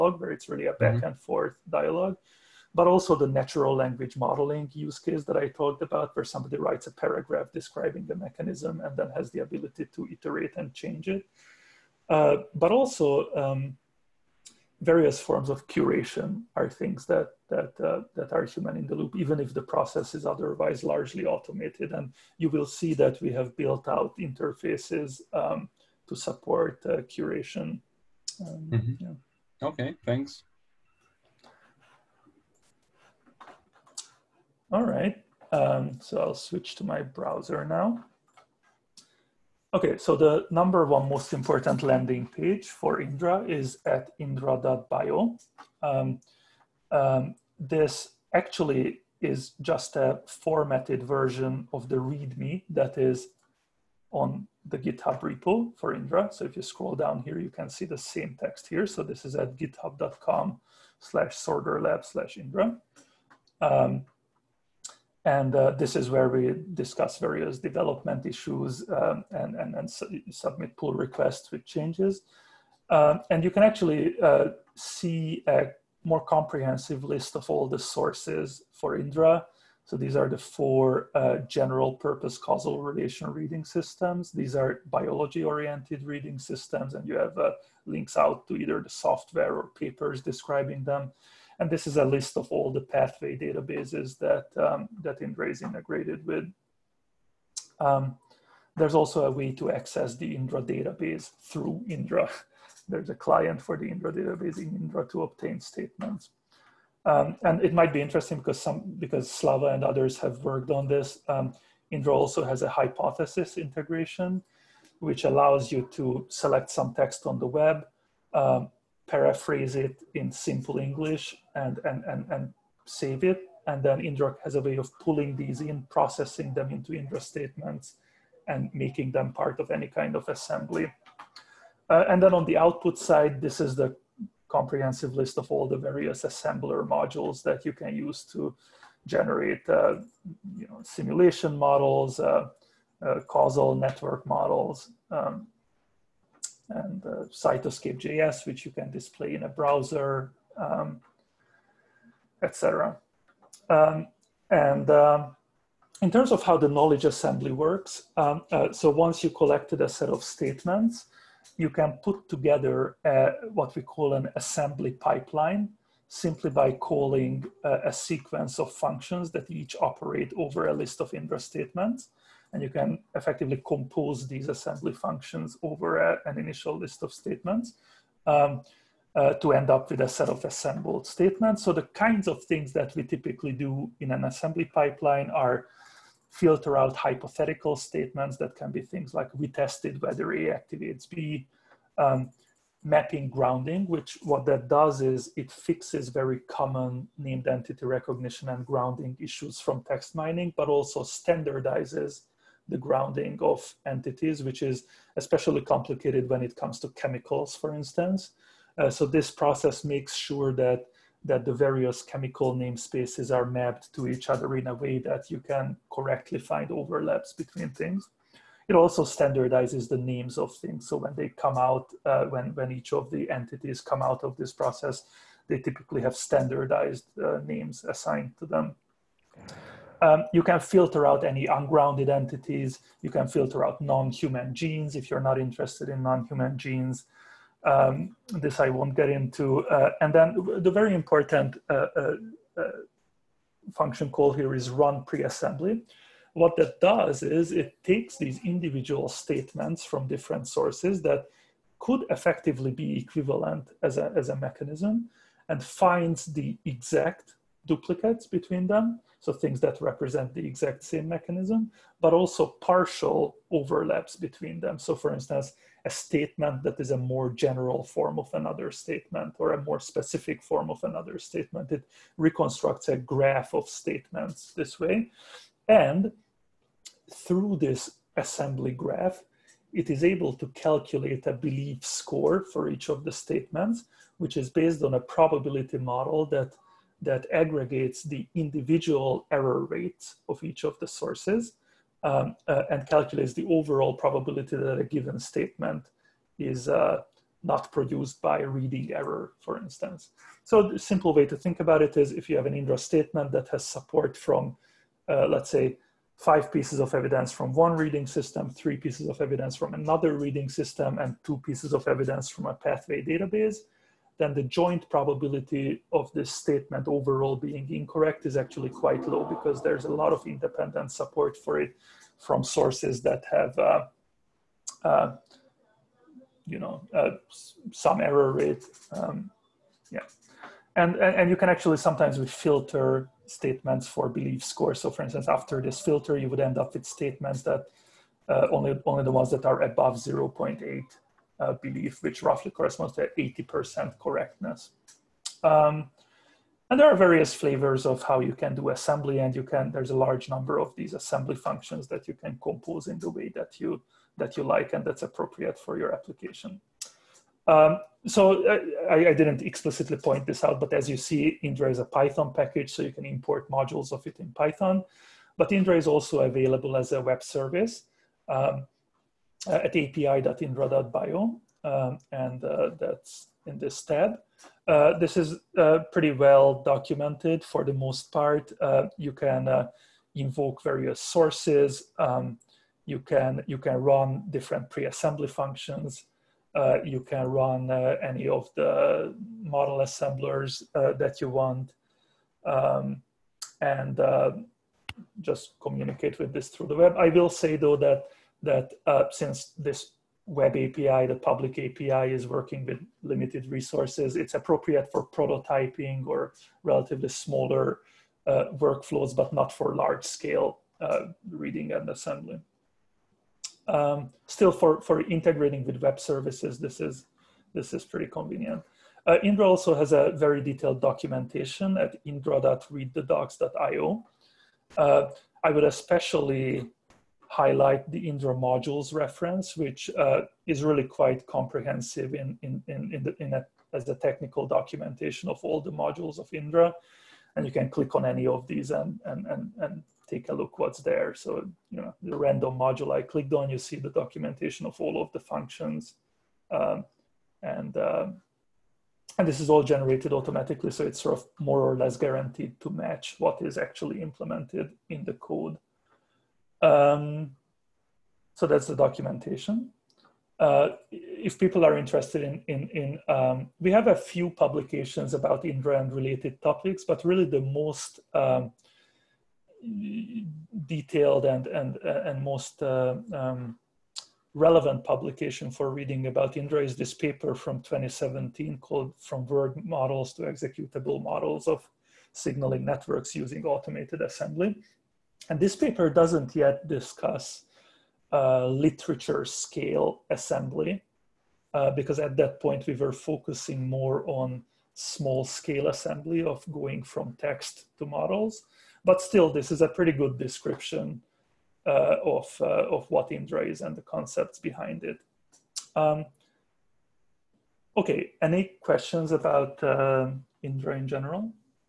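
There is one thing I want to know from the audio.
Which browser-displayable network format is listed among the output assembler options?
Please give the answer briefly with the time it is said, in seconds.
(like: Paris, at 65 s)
Cytoscape.js, at 147 s.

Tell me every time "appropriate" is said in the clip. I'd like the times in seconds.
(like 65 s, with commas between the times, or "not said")
355 s, 404 s.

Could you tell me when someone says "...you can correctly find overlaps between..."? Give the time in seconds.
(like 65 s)
215 s.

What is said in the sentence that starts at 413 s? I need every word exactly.
Um, still for, for integrating with web services, this is, this is pretty convenient.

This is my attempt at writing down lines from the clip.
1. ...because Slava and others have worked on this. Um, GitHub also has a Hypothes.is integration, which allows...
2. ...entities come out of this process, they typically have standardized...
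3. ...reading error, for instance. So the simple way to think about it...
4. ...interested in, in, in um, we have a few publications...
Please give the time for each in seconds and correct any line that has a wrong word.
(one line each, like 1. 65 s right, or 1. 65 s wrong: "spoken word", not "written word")
1. 108 s wrong: "Indra", not "GitHub"
2. 223 s right
3. 298 s right
4. 461 s right.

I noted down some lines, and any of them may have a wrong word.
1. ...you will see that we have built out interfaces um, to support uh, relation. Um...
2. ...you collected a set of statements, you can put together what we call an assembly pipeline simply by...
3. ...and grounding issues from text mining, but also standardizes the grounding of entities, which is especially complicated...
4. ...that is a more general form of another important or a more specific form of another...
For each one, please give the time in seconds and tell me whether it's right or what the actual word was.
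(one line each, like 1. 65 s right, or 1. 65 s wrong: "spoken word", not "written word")
1. 22 s wrong: "curation", not "relation"
2. 159 s right
3. 198 s right
4. 266 s wrong: "statement", not "important".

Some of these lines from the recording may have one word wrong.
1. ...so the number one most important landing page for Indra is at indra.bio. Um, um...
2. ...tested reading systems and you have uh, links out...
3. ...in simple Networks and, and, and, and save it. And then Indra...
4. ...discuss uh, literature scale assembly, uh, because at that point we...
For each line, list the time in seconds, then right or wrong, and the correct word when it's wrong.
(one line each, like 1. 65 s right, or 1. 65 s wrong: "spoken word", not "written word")
1. 39 s right
2. 85 s wrong: "oriented", not "tested"
3. 120 s wrong: "English", not "Networks"
4. 486 s right.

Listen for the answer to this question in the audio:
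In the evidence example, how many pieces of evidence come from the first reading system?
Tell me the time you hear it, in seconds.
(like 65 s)
306 s.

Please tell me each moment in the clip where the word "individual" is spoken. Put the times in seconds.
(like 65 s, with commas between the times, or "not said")
248 s, 288 s.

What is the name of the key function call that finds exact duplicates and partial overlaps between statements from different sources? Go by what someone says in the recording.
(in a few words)
run pre-assembly.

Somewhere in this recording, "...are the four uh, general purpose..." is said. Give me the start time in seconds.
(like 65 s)
80 s.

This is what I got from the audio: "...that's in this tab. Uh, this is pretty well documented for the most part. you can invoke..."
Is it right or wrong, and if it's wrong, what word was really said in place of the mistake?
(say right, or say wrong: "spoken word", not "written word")
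right.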